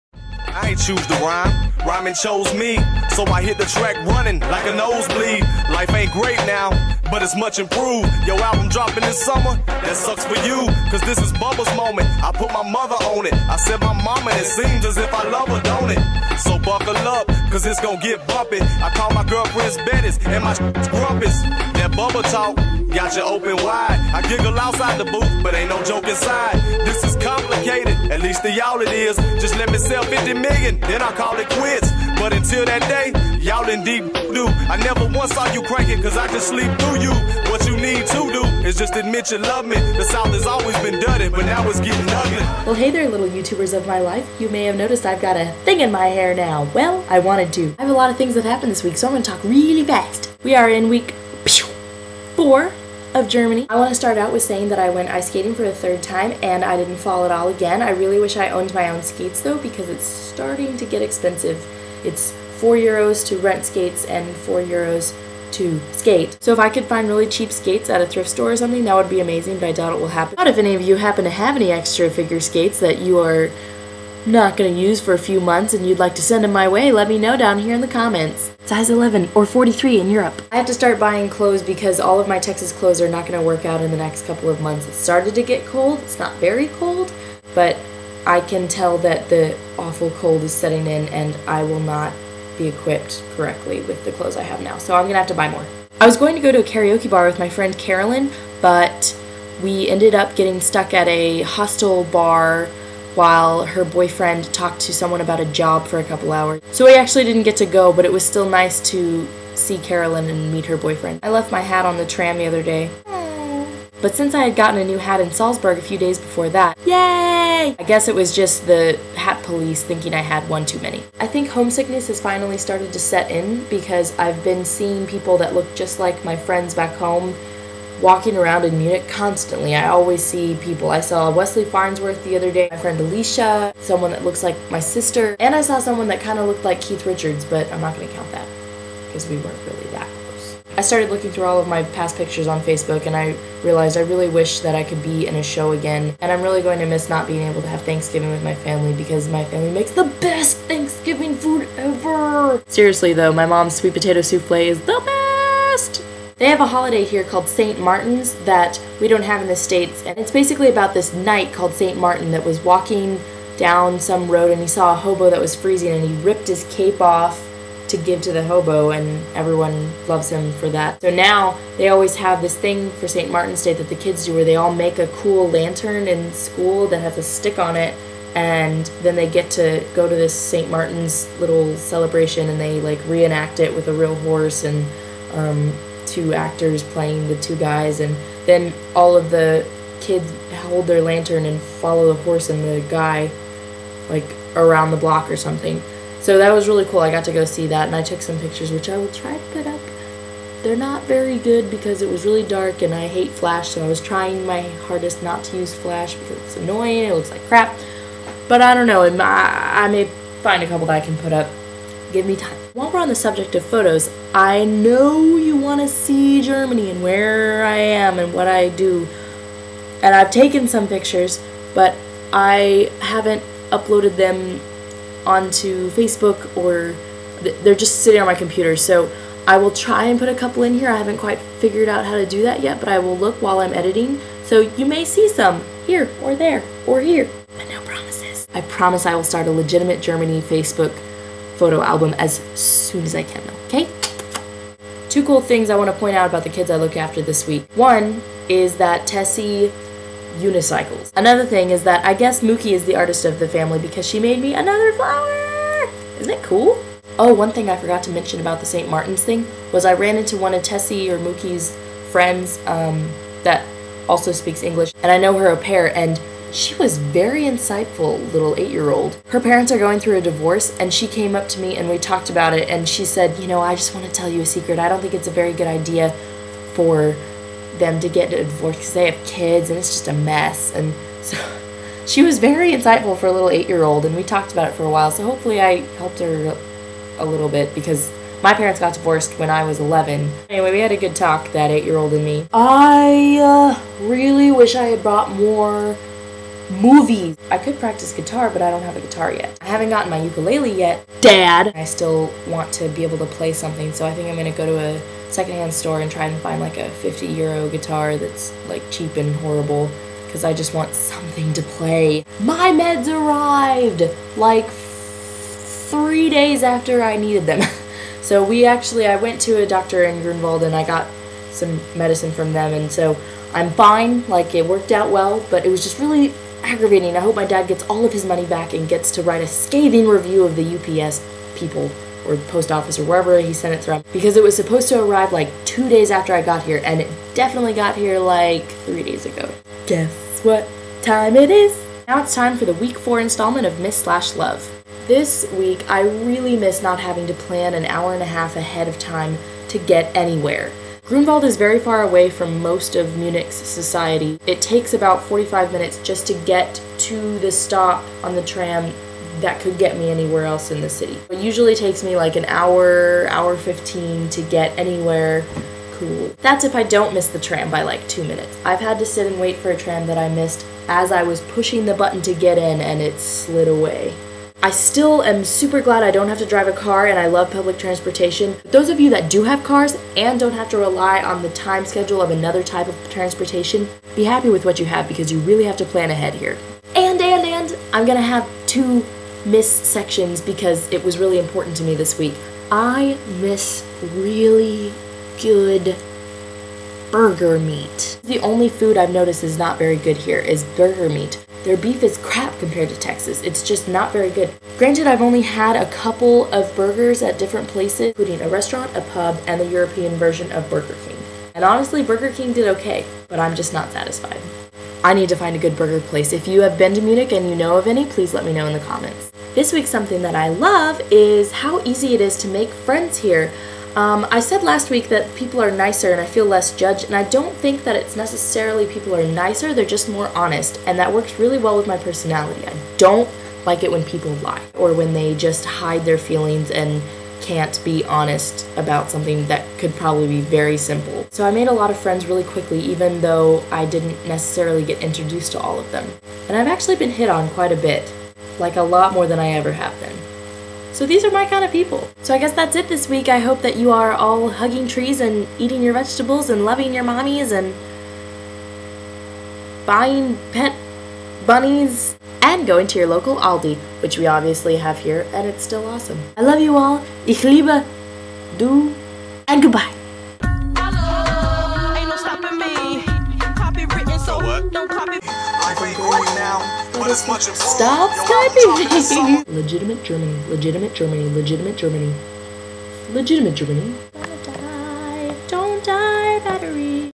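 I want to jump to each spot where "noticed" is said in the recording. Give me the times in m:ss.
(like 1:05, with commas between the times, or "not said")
0:44, 6:39.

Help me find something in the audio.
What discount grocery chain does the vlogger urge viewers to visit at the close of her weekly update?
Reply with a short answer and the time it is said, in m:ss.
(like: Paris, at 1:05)
Aldi, at 7:43.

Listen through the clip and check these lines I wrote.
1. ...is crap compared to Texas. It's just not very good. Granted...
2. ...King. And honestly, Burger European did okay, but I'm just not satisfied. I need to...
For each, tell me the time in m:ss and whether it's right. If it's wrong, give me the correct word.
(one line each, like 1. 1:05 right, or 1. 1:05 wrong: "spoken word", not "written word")
1. 6:42 right
2. 6:51 wrong: "King", not "European".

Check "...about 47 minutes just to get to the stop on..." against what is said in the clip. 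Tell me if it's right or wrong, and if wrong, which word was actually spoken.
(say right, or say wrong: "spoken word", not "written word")
wrong: "45", not "47".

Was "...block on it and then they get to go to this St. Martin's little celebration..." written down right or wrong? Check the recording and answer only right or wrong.
wrong.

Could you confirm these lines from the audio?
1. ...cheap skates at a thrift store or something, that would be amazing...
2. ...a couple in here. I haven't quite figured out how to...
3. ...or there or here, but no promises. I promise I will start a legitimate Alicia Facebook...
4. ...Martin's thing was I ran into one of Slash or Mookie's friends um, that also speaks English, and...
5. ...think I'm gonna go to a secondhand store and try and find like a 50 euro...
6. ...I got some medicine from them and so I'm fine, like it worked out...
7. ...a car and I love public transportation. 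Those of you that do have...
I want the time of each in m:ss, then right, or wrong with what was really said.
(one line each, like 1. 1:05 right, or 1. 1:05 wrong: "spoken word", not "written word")
1. 1:07 right
2. 3:50 right
3. 3:56 wrong: "Germany", not "Alicia"
4. 4:18 wrong: "Tessie", not "Slash"
5. 5:04 right
6. 5:20 right
7. 6:16 right.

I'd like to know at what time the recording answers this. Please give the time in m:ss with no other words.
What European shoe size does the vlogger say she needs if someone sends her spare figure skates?
1:19.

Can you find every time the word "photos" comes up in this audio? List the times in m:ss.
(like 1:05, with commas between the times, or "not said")
3:33, 4:01.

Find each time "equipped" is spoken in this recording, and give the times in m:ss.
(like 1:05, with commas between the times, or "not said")
1:32.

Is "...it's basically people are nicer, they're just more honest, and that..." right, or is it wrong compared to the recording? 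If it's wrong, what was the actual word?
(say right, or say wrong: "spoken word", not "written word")
wrong: "necessarily", not "basically".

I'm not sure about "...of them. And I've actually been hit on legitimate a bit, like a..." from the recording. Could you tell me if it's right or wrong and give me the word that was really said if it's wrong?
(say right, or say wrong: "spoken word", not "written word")
wrong: "quite", not "legitimate".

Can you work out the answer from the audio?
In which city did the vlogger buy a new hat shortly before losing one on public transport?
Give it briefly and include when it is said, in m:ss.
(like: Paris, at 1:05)
Salzburg, at 1:55.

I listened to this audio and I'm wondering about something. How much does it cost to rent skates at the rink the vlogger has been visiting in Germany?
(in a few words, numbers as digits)
4 euros.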